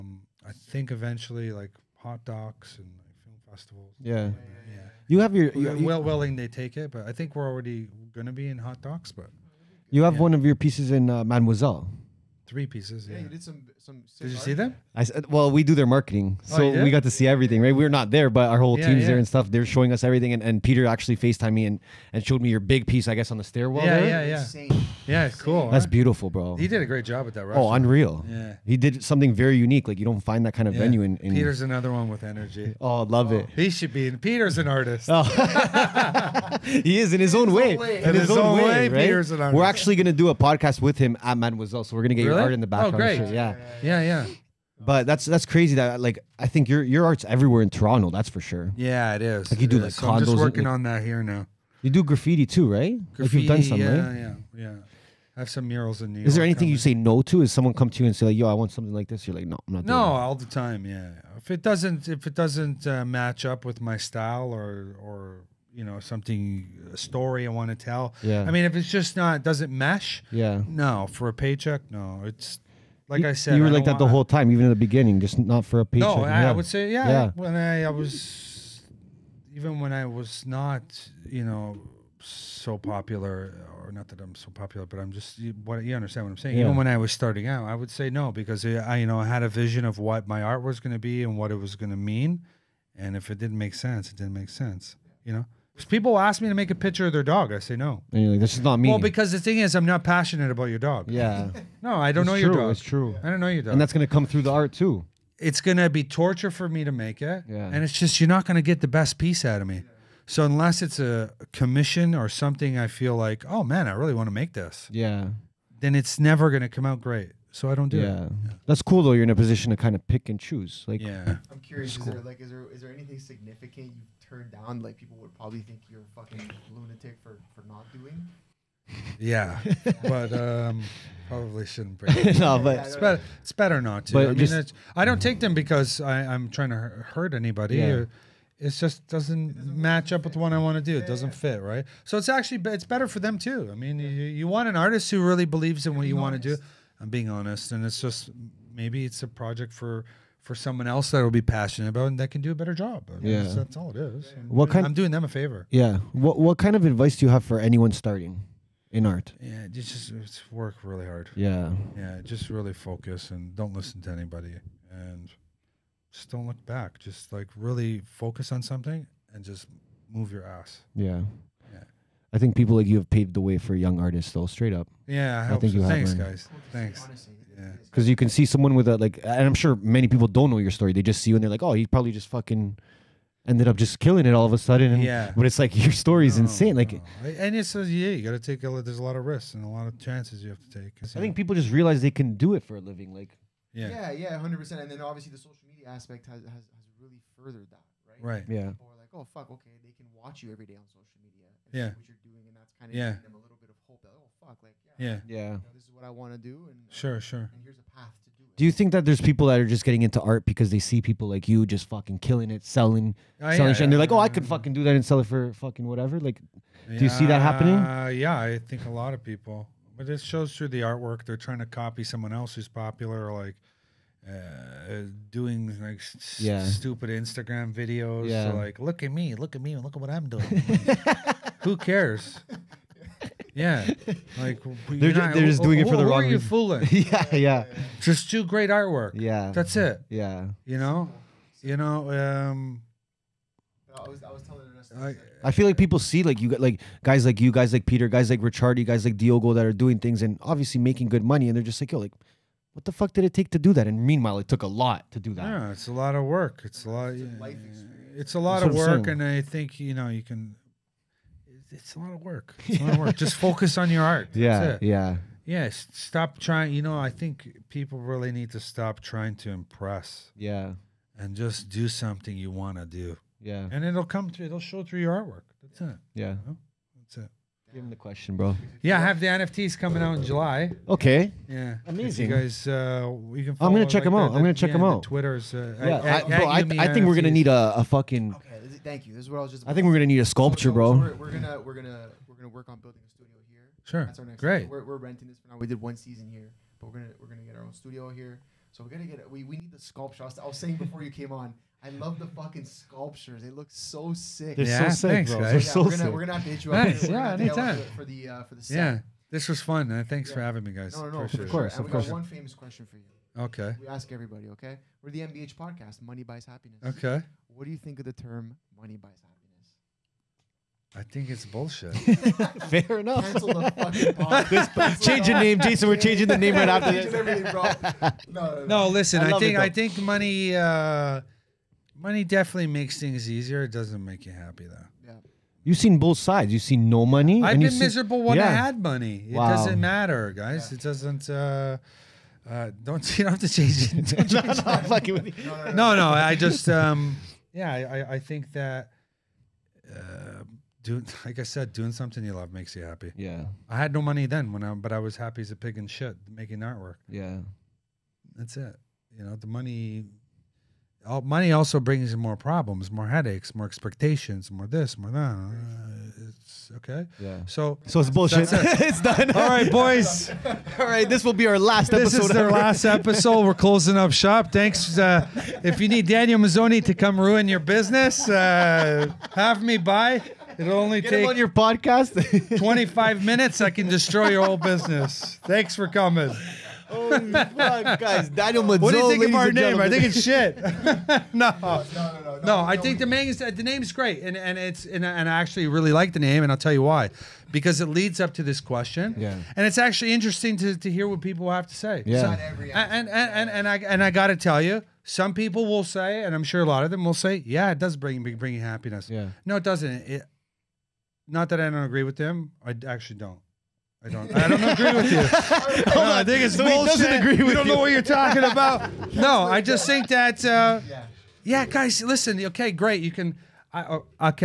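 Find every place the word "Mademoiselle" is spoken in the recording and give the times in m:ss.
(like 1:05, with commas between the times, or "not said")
0:11, 0:41.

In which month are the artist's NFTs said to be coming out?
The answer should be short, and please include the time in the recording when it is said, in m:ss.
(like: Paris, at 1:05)
July, at 4:40.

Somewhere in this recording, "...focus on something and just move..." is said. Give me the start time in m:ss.
2:48.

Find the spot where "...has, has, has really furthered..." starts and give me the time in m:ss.
3:16.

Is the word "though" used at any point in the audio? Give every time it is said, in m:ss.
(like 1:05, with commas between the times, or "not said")
1:59, 2:54, 5:34.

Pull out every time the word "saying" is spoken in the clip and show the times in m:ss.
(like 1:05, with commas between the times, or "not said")
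1:26, 5:00.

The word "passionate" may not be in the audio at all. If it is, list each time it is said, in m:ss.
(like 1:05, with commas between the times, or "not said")
1:40, 2:31.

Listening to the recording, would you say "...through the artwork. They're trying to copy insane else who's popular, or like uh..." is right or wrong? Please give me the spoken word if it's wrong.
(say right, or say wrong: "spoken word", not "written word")
wrong: "someone", not "insane".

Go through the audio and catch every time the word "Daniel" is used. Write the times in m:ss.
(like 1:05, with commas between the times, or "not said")
6:16, 6:28.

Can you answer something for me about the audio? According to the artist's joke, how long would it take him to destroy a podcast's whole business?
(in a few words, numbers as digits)
25 minutes.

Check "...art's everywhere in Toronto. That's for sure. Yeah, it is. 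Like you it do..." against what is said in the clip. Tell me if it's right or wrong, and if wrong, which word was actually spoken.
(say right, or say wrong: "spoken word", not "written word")
right.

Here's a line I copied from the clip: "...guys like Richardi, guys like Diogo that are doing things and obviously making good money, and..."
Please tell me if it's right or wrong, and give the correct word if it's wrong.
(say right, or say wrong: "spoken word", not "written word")
right.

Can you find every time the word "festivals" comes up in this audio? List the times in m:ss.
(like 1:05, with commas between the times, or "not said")
0:03.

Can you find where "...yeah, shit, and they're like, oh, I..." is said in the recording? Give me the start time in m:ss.
3:33.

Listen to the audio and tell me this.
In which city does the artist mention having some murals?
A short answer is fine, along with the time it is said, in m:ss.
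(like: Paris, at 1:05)
New York, at 0:56.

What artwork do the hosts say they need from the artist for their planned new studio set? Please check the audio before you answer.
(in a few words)
a sculpture.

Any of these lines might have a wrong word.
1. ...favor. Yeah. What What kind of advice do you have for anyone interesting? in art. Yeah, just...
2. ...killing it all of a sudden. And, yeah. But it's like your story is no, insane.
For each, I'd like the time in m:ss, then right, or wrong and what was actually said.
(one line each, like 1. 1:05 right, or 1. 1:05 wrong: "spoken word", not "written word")
1. 2:35 wrong: "starting", not "interesting"
2. 3:03 right.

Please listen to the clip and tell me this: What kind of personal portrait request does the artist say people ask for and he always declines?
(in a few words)
a picture of their dog.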